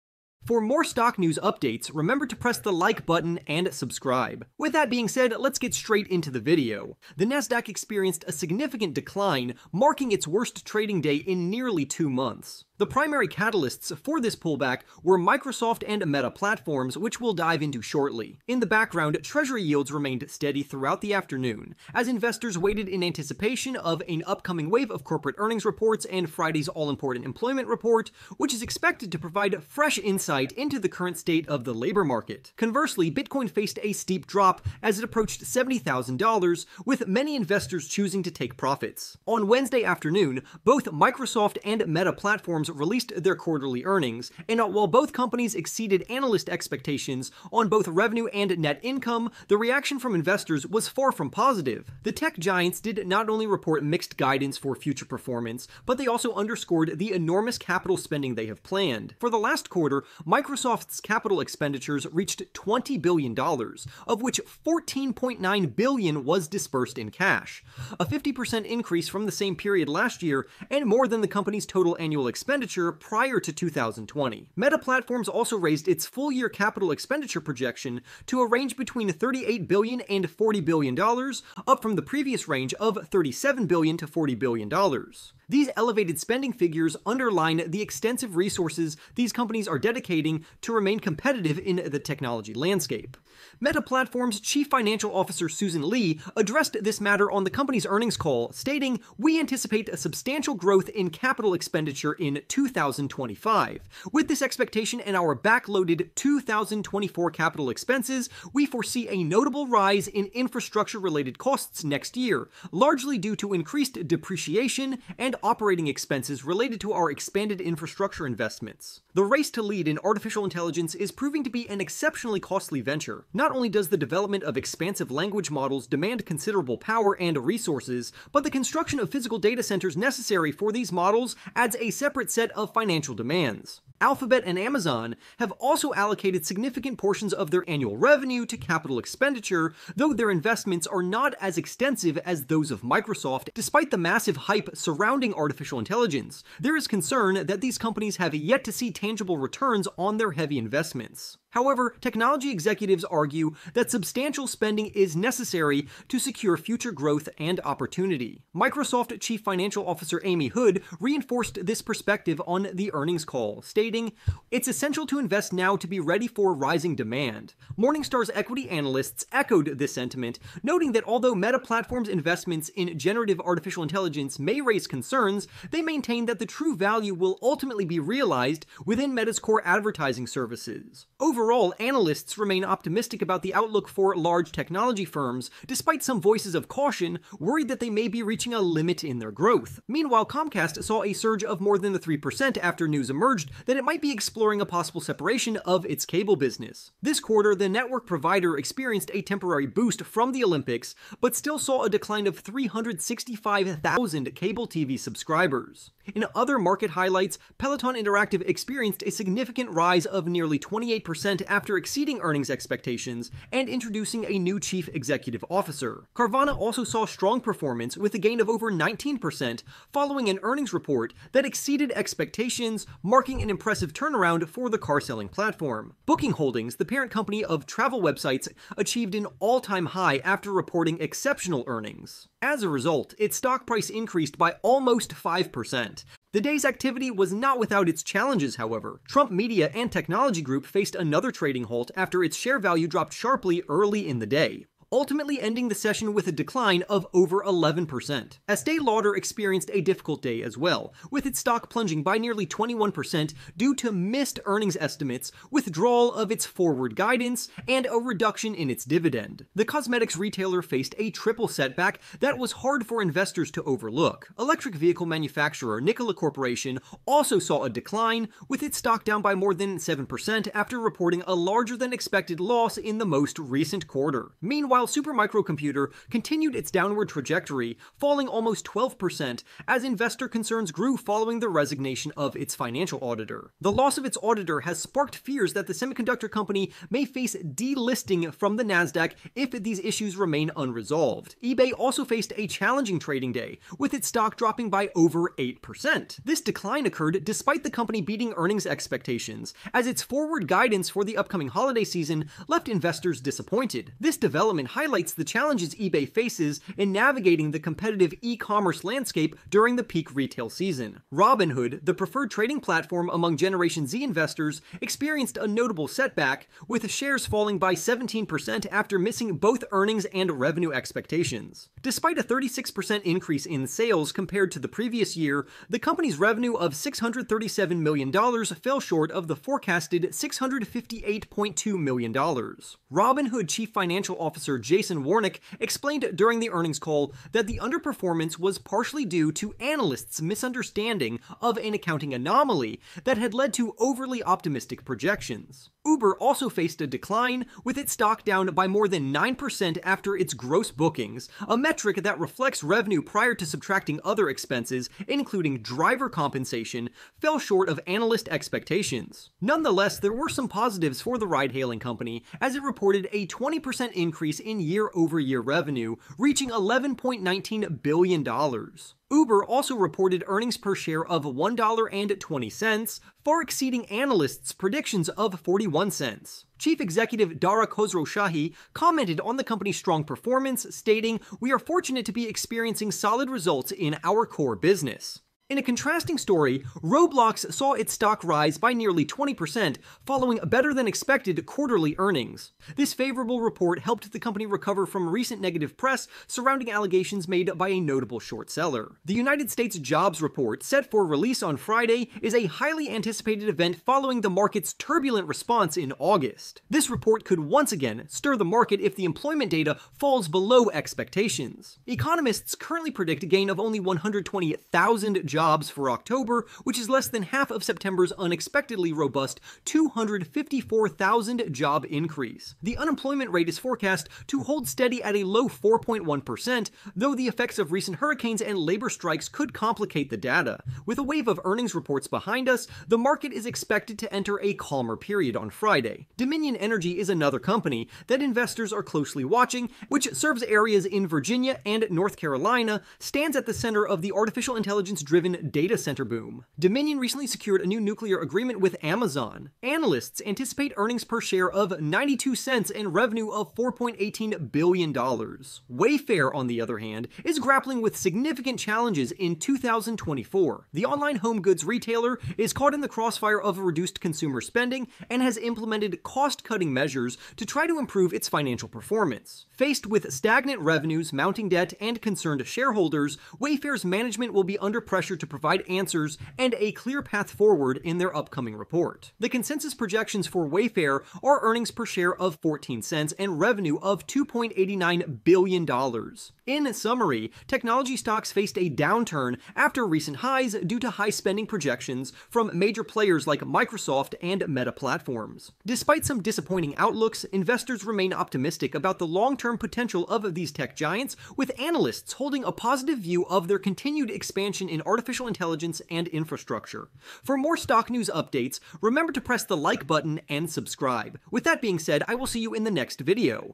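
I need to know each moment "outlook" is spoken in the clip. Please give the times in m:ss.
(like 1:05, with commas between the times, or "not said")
3:03, 8:16.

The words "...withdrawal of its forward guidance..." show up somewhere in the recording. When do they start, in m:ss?
4:15.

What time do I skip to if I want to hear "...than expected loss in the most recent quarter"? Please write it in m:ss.
4:31.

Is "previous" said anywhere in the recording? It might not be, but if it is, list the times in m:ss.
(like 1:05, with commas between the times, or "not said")
1:22, 5:24.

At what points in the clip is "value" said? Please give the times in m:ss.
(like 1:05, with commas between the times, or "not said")
2:56, 4:02.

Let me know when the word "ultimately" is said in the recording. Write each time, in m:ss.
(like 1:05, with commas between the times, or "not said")
2:57, 4:04.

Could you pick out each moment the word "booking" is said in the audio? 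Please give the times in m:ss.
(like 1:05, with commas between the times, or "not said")
3:46, 5:50.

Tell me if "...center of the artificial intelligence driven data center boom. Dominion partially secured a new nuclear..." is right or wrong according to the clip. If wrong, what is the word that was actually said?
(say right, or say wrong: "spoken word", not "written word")
wrong: "recently", not "partially".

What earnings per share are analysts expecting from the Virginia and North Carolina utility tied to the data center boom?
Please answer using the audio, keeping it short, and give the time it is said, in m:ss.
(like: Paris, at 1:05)
92 cents, at 7:31.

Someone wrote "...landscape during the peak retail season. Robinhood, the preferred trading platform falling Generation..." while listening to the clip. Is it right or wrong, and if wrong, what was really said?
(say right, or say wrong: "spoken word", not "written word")
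wrong: "among", not "falling".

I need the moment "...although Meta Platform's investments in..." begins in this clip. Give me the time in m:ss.
2:51.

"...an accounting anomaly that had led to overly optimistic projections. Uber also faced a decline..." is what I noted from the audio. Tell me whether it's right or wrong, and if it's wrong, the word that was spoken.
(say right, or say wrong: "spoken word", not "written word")
right.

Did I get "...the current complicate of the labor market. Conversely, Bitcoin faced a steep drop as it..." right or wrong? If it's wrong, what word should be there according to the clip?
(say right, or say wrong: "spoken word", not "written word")
wrong: "state", not "complicate".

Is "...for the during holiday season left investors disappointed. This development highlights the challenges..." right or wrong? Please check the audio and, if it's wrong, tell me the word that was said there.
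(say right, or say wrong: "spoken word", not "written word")
wrong: "upcoming", not "during".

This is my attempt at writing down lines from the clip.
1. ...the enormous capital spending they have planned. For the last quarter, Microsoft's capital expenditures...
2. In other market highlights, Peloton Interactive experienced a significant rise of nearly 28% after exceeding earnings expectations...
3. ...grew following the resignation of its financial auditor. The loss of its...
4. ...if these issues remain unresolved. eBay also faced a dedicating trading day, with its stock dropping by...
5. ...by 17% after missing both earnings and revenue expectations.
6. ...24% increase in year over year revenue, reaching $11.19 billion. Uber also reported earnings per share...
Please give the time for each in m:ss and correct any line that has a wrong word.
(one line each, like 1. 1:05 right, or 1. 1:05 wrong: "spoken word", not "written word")
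1. 0:56 right
2. 3:26 right
3. 4:40 right
4. 4:49 wrong: "challenging", not "dedicating"
5. 5:17 right
6. 6:03 wrong: "20", not "24".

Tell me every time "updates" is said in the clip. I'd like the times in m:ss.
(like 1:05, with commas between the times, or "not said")
0:01, 8:28.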